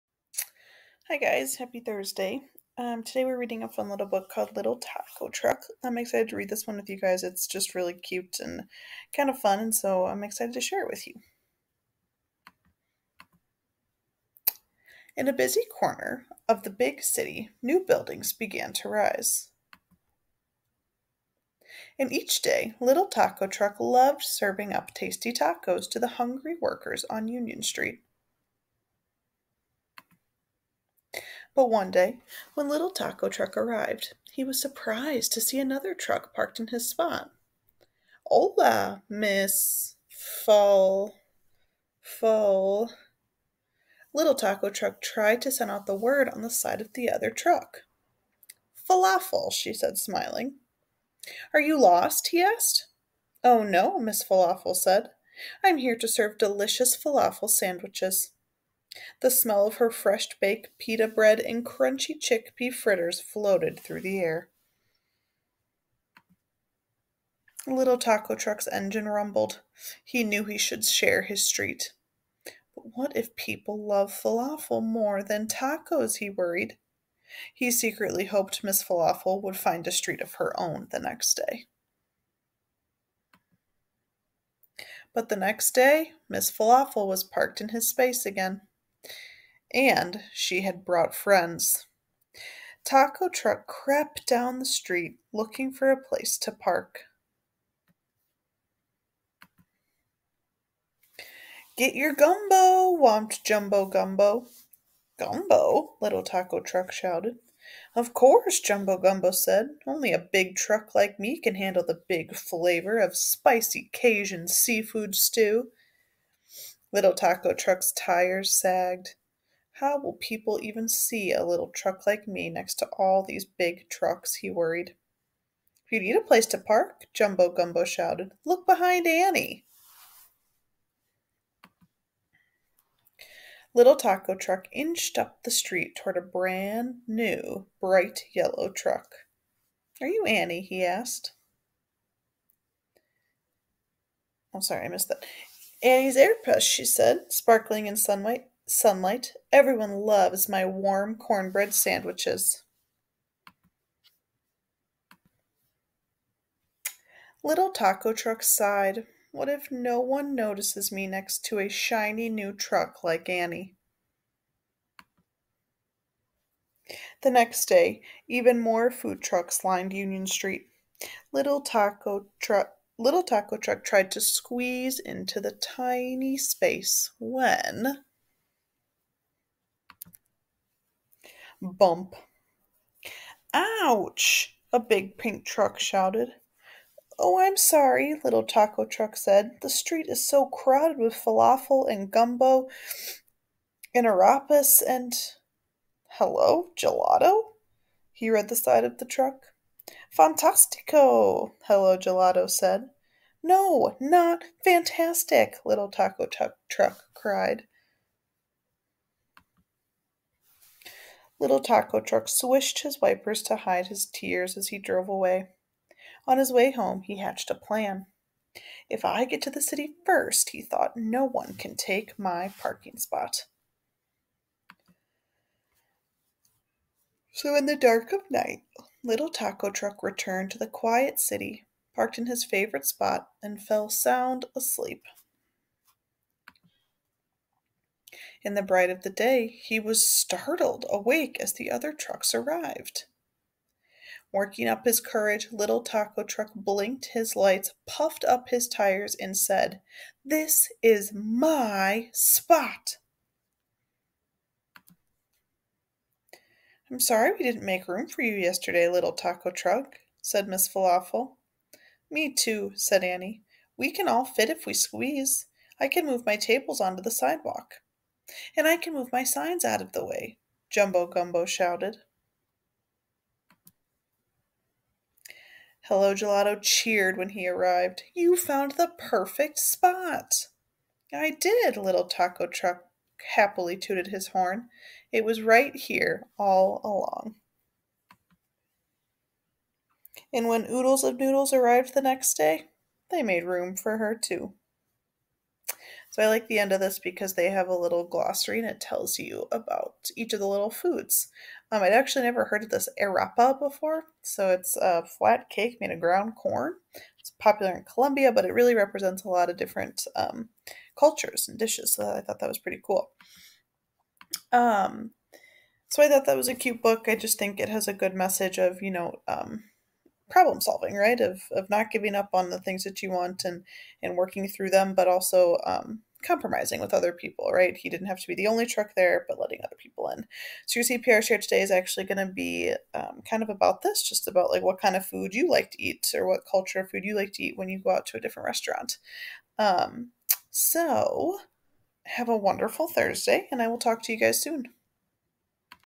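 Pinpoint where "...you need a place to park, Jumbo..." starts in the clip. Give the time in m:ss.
2:05.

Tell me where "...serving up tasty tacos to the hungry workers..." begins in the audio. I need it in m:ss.
0:24.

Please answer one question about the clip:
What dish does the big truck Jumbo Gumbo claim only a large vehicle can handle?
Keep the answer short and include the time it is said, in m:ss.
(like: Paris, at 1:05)
spicy Cajun seafood stew, at 1:53.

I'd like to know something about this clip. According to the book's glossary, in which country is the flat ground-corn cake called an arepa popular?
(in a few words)
Colombia.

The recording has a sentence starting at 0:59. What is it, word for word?
The smell of her fresh baked pita bread and crunchy chickpea fritters floated through the air.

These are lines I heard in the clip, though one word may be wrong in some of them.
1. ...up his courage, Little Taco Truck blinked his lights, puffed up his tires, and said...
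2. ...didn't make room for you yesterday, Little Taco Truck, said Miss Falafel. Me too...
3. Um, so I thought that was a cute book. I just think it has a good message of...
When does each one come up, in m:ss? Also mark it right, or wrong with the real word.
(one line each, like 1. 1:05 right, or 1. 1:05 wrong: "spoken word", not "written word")
1. 4:04 right
2. 4:17 right
3. 5:14 right.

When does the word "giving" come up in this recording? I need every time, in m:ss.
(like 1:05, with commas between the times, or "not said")
5:21.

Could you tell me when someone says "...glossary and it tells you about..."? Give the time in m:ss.
4:58.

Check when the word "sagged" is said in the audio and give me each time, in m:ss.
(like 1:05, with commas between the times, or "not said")
1:58.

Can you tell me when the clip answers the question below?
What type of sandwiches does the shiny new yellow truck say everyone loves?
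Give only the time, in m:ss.
2:31.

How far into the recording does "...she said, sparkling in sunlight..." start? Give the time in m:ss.
2:26.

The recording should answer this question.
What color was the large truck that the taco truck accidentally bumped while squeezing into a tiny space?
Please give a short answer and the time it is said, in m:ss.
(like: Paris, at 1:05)
pink, at 3:05.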